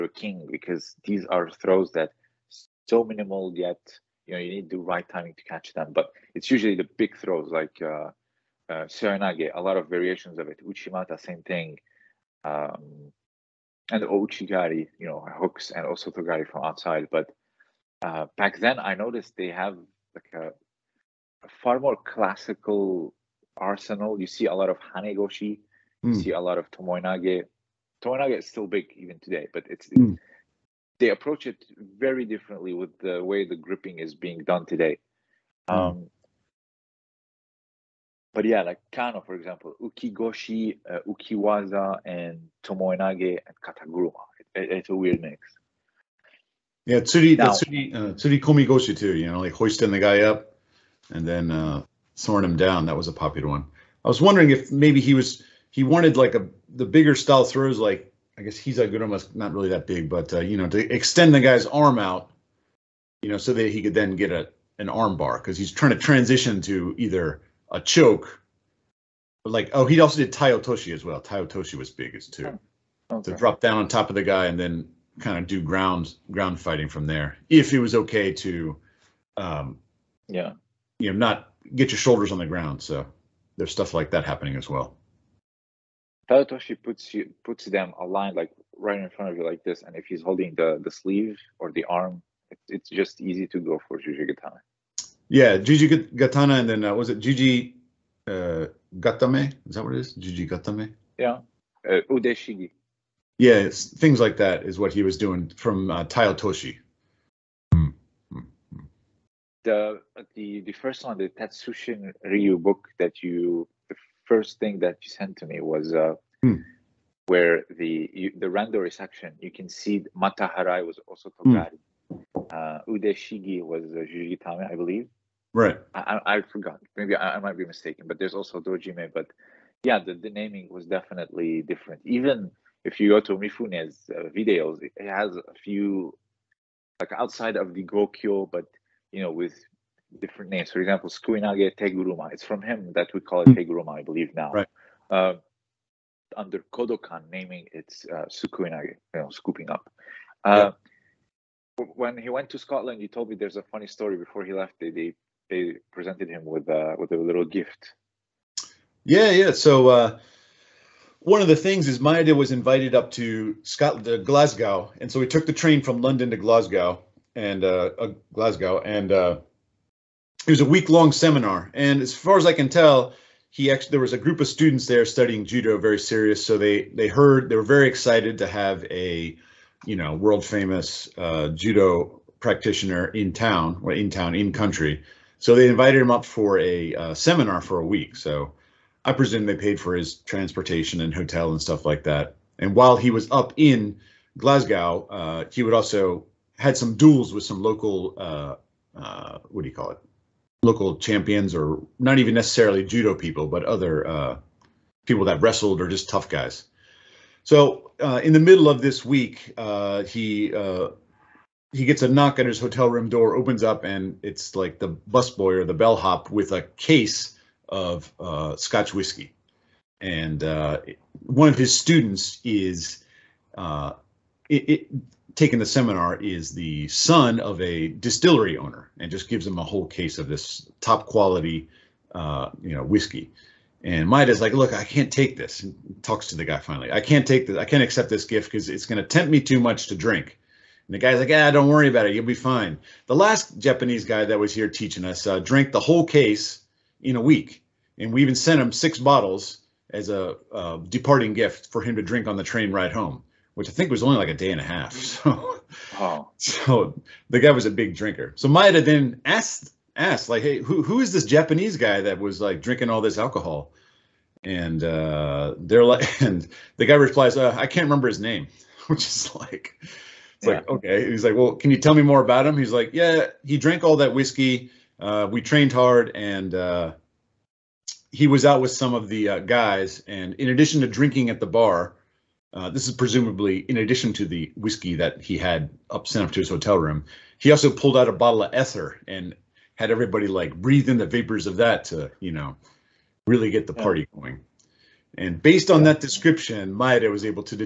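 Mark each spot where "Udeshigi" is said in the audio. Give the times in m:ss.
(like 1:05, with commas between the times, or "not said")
1:42, 2:02.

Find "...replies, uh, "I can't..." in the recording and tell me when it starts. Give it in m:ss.
4:26.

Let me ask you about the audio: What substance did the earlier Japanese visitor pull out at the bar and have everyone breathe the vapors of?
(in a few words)
ether.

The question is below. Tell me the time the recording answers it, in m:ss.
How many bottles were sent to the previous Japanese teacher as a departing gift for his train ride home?
4:08.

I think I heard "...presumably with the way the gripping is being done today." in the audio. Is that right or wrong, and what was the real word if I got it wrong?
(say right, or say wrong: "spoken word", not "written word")
wrong: "differently", not "presumably".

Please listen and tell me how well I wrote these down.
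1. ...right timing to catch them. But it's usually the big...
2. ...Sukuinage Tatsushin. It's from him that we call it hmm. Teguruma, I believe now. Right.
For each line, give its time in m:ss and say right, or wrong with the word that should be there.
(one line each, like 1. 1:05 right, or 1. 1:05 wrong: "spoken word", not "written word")
1. 0:04 right
2. 2:21 wrong: "Teguruma", not "Tatsushin".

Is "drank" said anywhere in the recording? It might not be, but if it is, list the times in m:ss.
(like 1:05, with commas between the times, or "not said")
4:05, 4:33.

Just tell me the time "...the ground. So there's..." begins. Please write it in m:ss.
1:22.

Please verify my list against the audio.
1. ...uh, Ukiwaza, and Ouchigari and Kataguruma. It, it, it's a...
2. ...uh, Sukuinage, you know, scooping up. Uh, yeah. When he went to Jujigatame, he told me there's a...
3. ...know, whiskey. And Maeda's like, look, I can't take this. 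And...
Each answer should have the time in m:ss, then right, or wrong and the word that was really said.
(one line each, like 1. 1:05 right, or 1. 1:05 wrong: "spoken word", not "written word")
1. 0:40 wrong: "Tomoenage", not "Ouchigari"
2. 2:28 wrong: "Scotland", not "Jujigatame"
3. 3:52 right.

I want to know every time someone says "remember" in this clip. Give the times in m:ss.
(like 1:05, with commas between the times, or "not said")
4:27.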